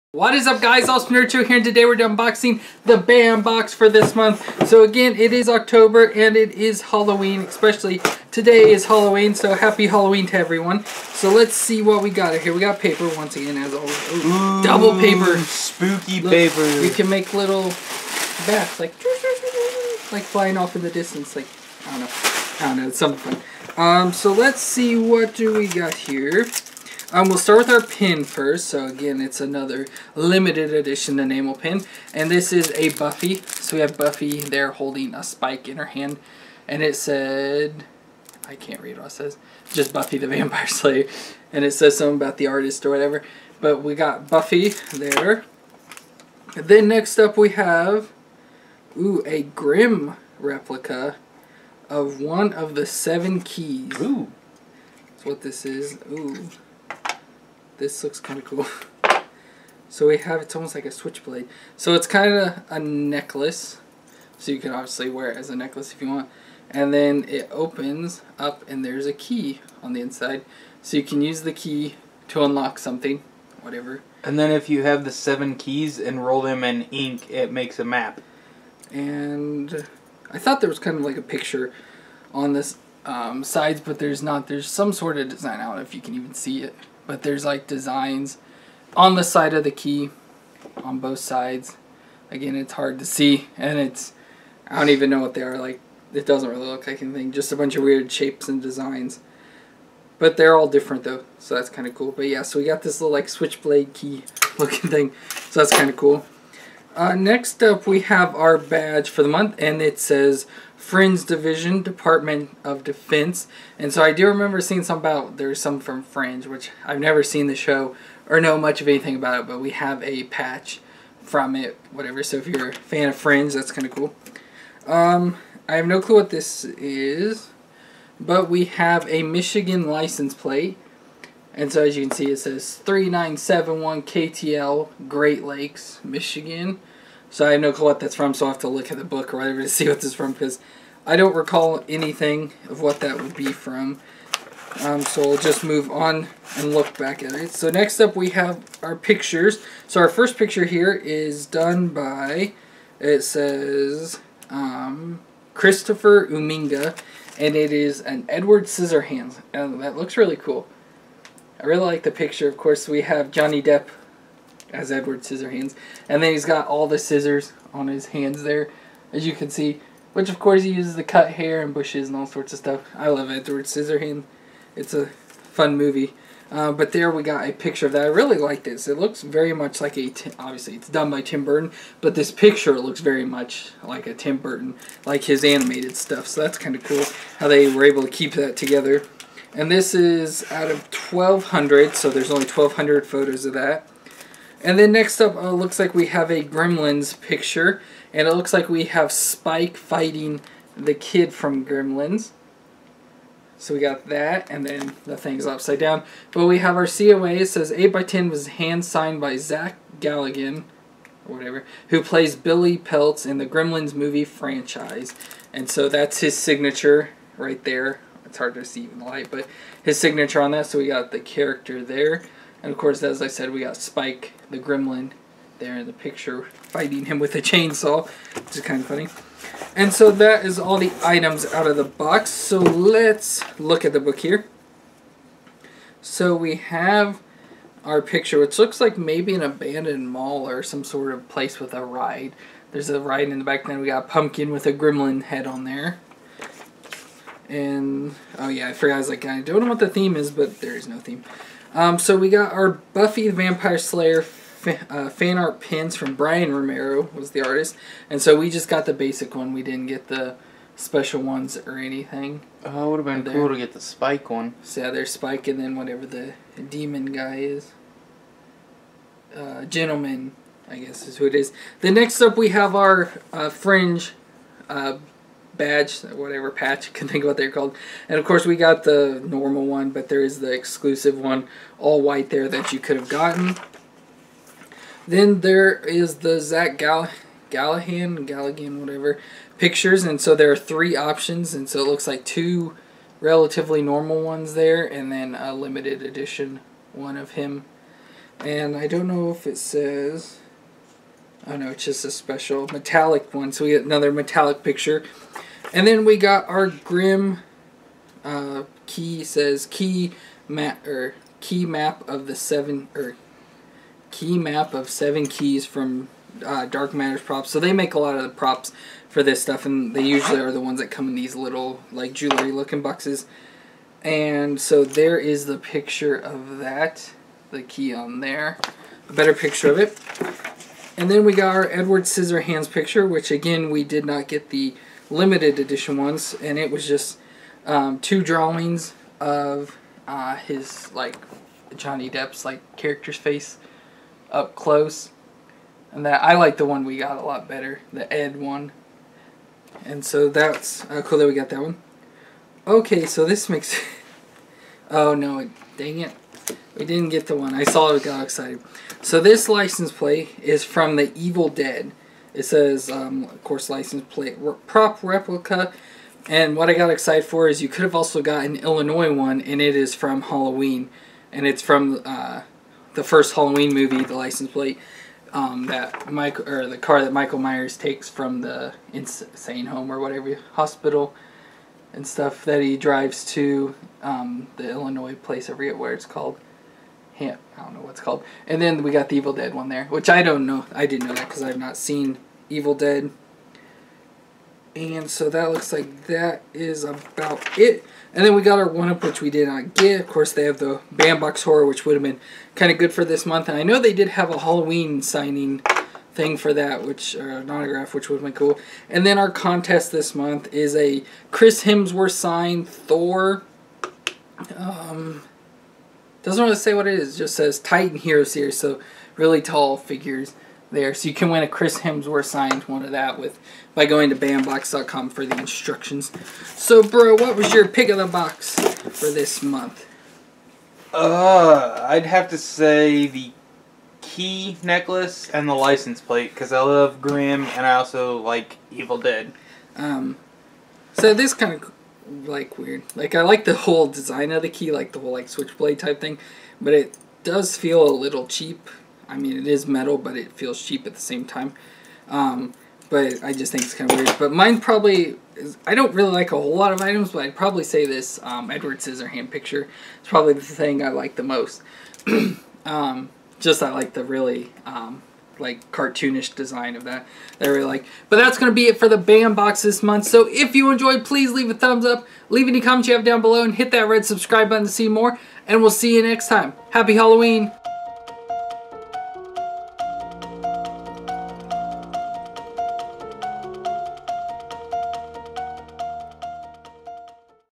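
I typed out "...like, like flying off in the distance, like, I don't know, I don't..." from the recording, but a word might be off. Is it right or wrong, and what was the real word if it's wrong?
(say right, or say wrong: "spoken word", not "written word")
right.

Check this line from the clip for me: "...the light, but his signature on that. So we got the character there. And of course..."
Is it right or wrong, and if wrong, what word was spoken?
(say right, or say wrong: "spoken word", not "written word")
right.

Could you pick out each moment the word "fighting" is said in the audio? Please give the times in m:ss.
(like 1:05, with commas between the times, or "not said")
3:19, 3:46.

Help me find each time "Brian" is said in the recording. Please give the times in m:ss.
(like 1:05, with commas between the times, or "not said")
4:16.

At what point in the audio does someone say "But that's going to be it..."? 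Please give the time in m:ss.
7:48.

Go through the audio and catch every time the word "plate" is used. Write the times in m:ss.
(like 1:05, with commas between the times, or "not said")
2:10, 5:59, 6:04, 6:14, 7:16.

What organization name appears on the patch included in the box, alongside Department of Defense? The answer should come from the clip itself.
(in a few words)
Fringe Division.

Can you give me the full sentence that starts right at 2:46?
And then he's got all the scissors on his hands there, as you can see.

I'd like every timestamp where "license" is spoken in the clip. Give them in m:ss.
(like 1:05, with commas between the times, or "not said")
2:09, 5:59, 6:03, 6:14, 7:15.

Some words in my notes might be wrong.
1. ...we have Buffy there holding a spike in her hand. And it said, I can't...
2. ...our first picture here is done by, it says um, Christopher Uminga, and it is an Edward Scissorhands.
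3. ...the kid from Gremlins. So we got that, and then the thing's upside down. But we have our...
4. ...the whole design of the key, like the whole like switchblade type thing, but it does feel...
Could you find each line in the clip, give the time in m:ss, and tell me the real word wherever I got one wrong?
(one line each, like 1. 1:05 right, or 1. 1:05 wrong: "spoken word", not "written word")
1. 0:33 right
2. 2:30 right
3. 3:20 right
4. 7:23 right.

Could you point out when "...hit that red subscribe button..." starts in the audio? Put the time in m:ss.
7:53.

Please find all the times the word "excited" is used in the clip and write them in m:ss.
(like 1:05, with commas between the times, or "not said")
5:58, 6:06.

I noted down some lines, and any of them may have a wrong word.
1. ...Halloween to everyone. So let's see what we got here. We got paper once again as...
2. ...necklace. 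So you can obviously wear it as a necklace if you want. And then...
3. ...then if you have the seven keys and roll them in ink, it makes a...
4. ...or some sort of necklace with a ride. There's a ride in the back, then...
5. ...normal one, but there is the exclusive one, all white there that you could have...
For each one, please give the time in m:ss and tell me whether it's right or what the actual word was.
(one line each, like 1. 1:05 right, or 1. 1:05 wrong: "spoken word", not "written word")
1. 0:09 right
2. 1:02 right
3. 1:14 right
4. 4:00 wrong: "place", not "necklace"
5. 4:39 right.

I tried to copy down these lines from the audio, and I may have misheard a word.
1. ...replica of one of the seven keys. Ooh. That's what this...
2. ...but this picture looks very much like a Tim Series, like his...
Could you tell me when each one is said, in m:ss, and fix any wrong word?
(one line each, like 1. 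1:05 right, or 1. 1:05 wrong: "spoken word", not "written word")
1. 0:50 right
2. 3:02 wrong: "Burton", not "Series".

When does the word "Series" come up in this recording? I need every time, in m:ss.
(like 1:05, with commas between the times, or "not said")
6:58.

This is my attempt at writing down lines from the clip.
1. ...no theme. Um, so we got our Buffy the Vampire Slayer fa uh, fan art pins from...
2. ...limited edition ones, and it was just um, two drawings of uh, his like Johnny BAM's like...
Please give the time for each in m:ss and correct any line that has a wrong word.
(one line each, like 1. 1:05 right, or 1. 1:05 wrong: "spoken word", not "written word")
1. 4:10 right
2. 5:35 wrong: "Depp", not "BAM".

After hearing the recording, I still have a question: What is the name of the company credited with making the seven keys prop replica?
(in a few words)
Dark Matters.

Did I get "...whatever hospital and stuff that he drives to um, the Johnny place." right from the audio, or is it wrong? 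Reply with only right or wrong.
wrong.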